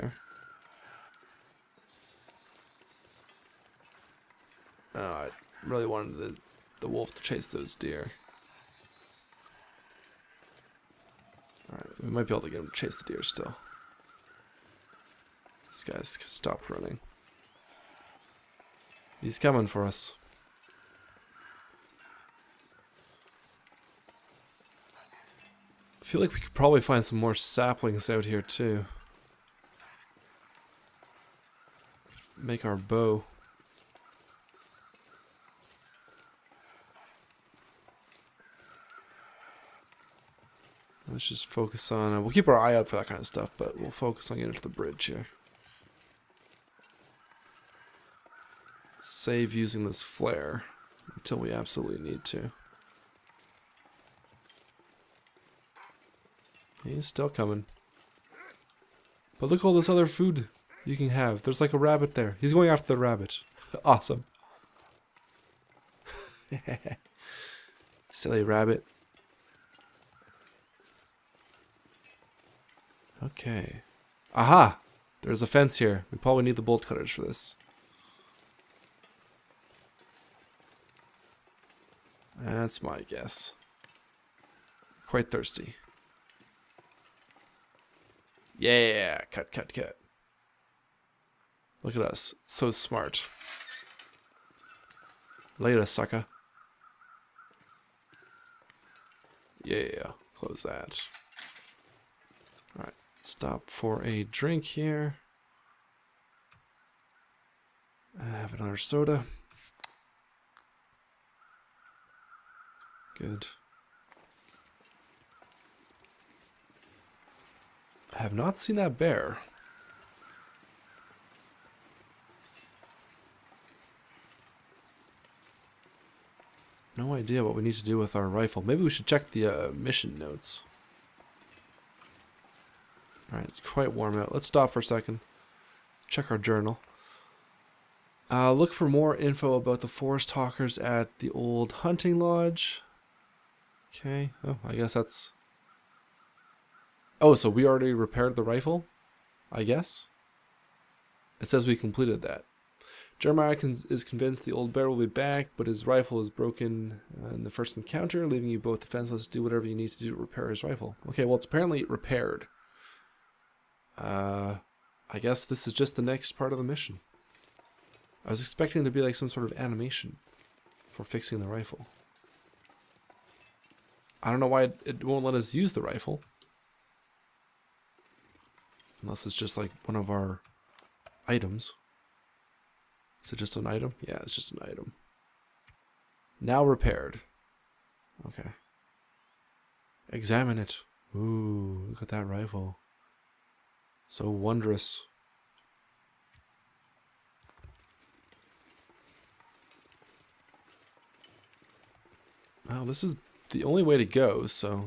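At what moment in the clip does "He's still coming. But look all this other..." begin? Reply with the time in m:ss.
0:56.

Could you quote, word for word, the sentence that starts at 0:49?
Save using this flare until we absolutely need to.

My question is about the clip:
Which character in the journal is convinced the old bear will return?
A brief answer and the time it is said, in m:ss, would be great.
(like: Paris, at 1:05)
Jeremiah, at 2:33.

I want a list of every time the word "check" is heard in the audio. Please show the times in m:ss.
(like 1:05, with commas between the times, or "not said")
2:09, 2:16.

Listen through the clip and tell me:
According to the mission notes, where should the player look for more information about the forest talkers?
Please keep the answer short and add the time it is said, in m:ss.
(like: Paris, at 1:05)
The old hunting lodge, at 2:21.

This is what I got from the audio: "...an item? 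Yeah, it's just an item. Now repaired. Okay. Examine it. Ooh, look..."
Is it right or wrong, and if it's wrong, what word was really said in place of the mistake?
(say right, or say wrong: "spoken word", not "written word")
right.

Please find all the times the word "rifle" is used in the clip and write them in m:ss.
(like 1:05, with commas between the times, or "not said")
2:08, 2:28, 2:35, 2:40, 2:51, 2:55, 3:12.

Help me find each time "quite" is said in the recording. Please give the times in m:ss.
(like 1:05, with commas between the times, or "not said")
1:25, 2:13.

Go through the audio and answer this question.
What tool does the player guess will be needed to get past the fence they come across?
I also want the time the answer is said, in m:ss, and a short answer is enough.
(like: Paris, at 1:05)
Bolt cutters, at 1:16.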